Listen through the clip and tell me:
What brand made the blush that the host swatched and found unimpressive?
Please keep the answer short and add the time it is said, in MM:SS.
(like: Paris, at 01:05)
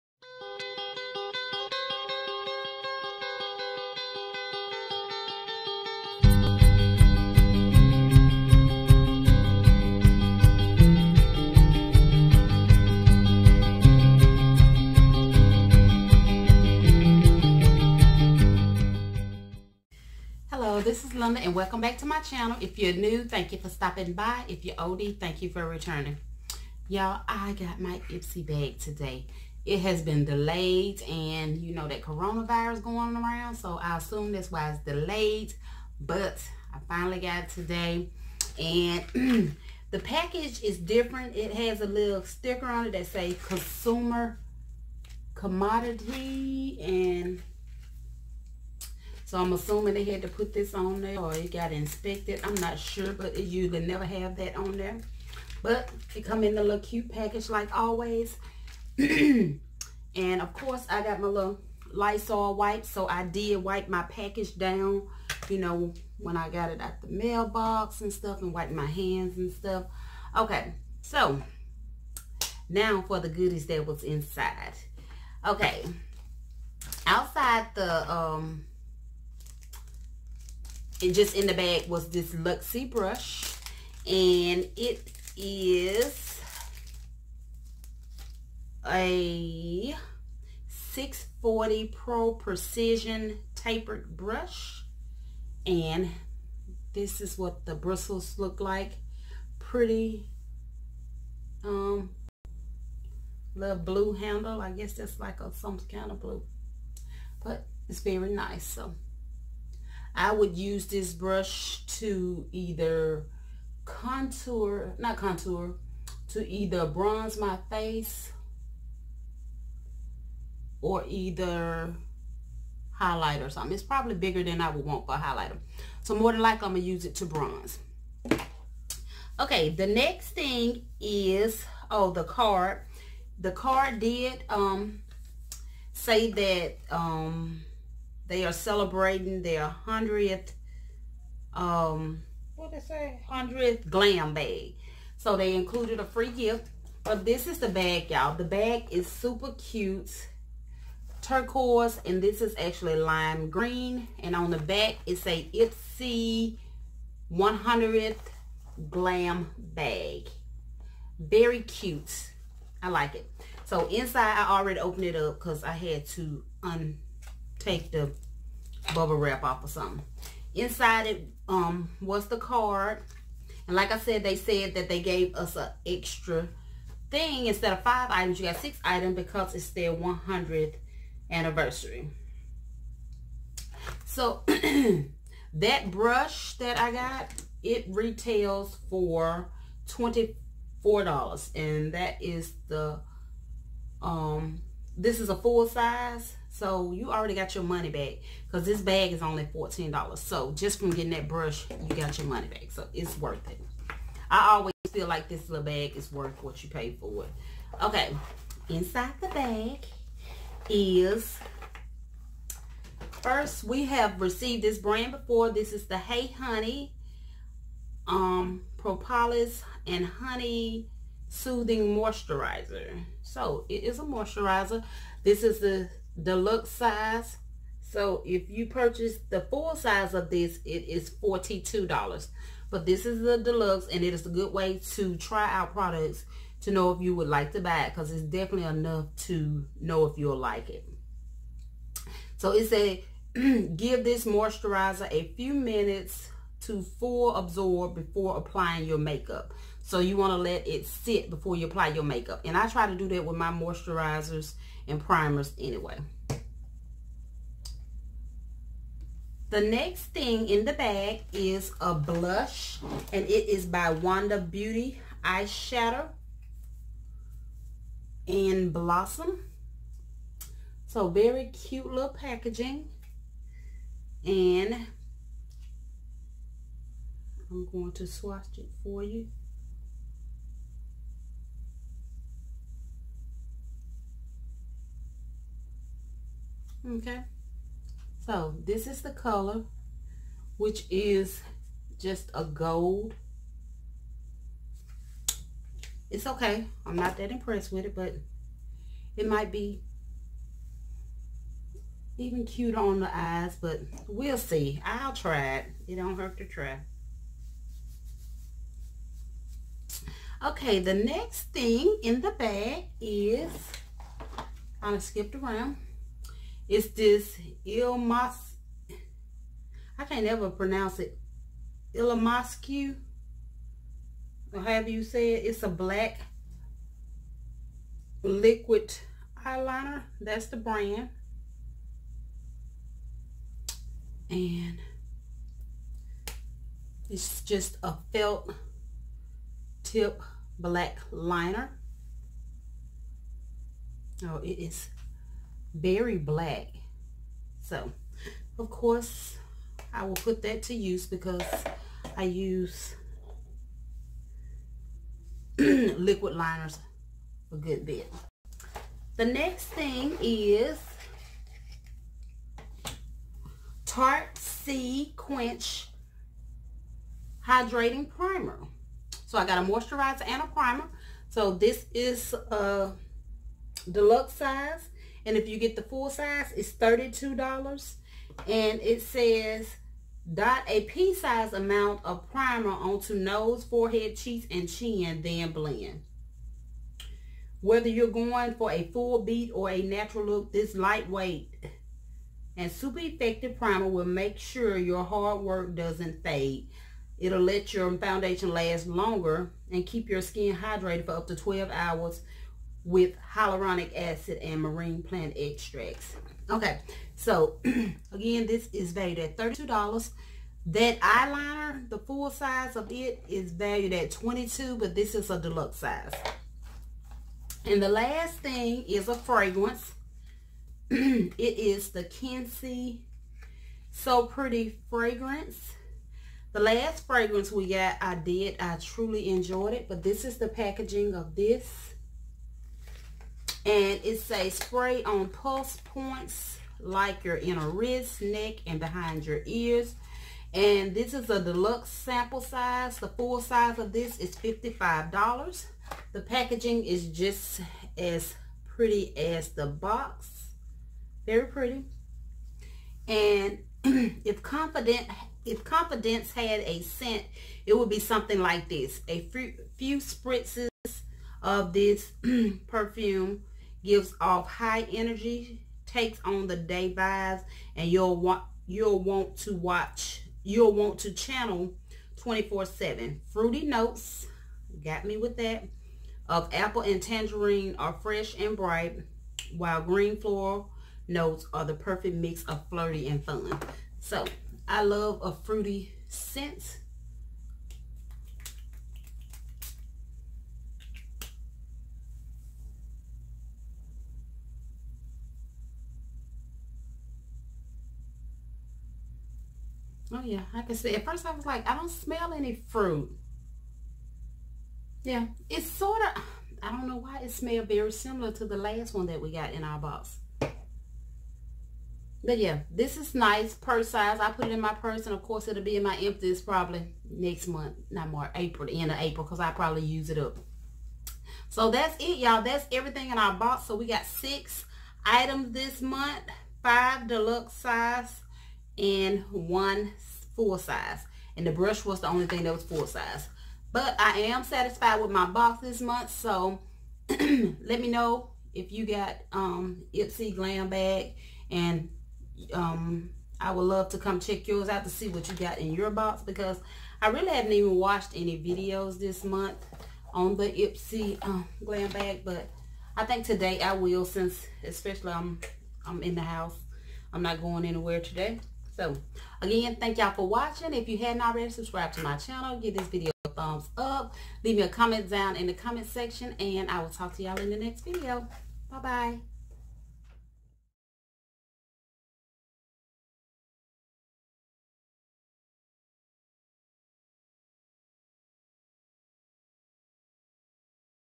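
Wander Beauty, at 04:23.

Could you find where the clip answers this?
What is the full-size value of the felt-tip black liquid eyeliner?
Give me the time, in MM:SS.
06:54.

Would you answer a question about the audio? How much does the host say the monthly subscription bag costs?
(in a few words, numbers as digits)
$14.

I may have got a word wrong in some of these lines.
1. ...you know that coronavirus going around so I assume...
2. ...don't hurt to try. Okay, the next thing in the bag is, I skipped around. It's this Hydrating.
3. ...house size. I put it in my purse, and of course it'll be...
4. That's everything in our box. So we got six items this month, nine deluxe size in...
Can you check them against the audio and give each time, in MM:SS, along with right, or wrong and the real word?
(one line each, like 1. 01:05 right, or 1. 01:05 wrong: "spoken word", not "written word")
1. 00:31 right
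2. 05:05 wrong: "Ilmas", not "Hydrating"
3. 08:33 wrong: "purse", not "house"
4. 08:42 wrong: "five", not "nine".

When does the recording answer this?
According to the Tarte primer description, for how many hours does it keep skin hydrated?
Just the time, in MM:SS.
06:41.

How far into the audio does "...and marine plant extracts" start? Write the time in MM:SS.
06:44.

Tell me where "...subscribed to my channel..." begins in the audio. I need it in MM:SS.
09:21.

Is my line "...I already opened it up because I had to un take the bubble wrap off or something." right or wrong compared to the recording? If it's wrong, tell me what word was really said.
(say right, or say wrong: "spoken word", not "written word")
right.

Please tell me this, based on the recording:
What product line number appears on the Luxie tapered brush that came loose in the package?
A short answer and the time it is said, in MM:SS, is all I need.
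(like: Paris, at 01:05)
640, at 01:30.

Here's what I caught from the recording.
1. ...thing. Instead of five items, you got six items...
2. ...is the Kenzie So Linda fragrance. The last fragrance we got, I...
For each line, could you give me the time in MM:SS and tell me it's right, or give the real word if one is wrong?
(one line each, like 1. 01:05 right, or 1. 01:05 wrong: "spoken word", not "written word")
1. 02:57 right
2. 07:01 wrong: "Pretty", not "Linda".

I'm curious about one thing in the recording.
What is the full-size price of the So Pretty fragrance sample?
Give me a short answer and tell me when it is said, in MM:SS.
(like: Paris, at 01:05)
$55, at 07:24.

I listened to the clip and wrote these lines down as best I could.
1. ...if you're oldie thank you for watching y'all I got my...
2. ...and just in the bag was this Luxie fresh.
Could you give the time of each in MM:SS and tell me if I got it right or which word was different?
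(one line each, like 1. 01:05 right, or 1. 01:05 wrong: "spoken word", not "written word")
1. 00:24 wrong: "returning", not "watching"
2. 01:21 wrong: "brush", not "fresh".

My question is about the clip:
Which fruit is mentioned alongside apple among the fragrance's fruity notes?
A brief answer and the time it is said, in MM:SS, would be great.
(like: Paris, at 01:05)
tangerine, at 07:57.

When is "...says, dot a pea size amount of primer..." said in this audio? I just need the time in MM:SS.
06:19.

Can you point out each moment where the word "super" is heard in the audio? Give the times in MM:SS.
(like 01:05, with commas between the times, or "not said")
02:29, 06:32.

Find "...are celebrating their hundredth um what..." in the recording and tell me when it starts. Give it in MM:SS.
02:18.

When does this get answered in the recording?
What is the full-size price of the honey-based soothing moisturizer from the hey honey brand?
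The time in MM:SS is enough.
03:51.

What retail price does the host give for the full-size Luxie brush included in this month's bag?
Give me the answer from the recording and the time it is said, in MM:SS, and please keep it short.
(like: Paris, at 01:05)
$24, at 03:09.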